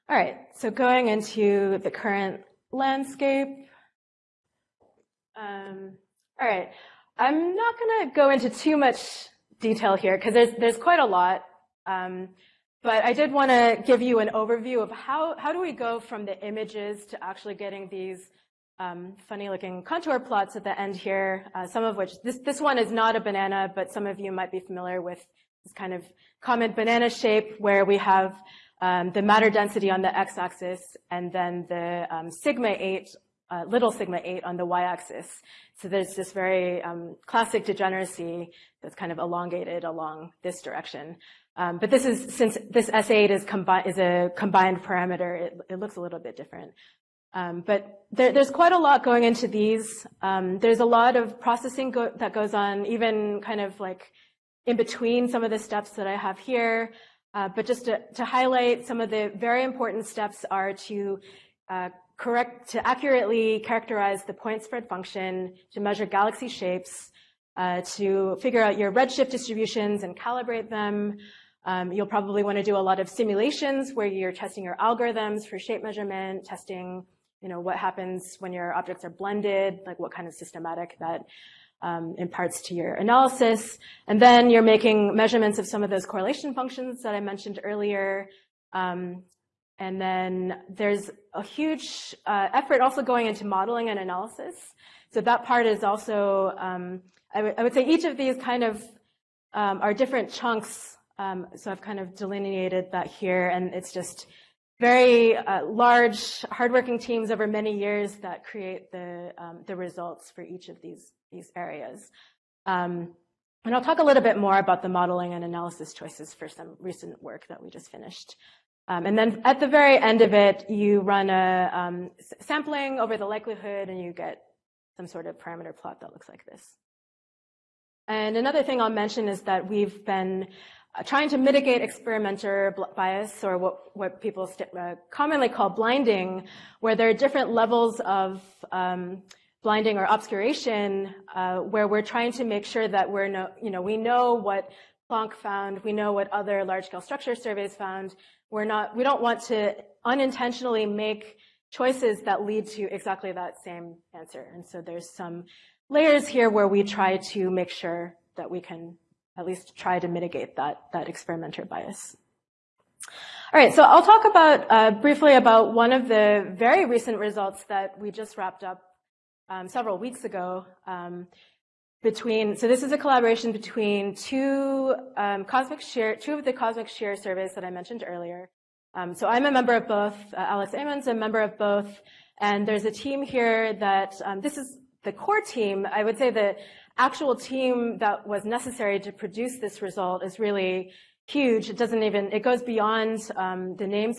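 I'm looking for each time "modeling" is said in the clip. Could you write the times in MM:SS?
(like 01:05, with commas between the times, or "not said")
01:33, 01:54.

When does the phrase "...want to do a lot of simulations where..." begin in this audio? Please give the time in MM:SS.
01:12.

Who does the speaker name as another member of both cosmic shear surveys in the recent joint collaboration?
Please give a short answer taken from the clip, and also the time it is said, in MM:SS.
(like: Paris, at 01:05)
Alex Amon, at 03:00.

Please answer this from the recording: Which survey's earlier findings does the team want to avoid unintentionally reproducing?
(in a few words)
Planck.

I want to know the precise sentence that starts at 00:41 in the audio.
Um, but this is, since this S8 is, combi- is a combined parameter, it, it looks a little bit different.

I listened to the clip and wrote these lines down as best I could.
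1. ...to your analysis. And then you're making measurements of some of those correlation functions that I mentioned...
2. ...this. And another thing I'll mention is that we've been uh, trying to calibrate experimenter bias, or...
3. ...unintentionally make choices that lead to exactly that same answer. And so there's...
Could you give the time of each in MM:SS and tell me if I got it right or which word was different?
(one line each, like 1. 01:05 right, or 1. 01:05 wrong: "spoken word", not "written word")
1. 01:22 right
2. 02:06 wrong: "mitigate", not "calibrate"
3. 02:30 right.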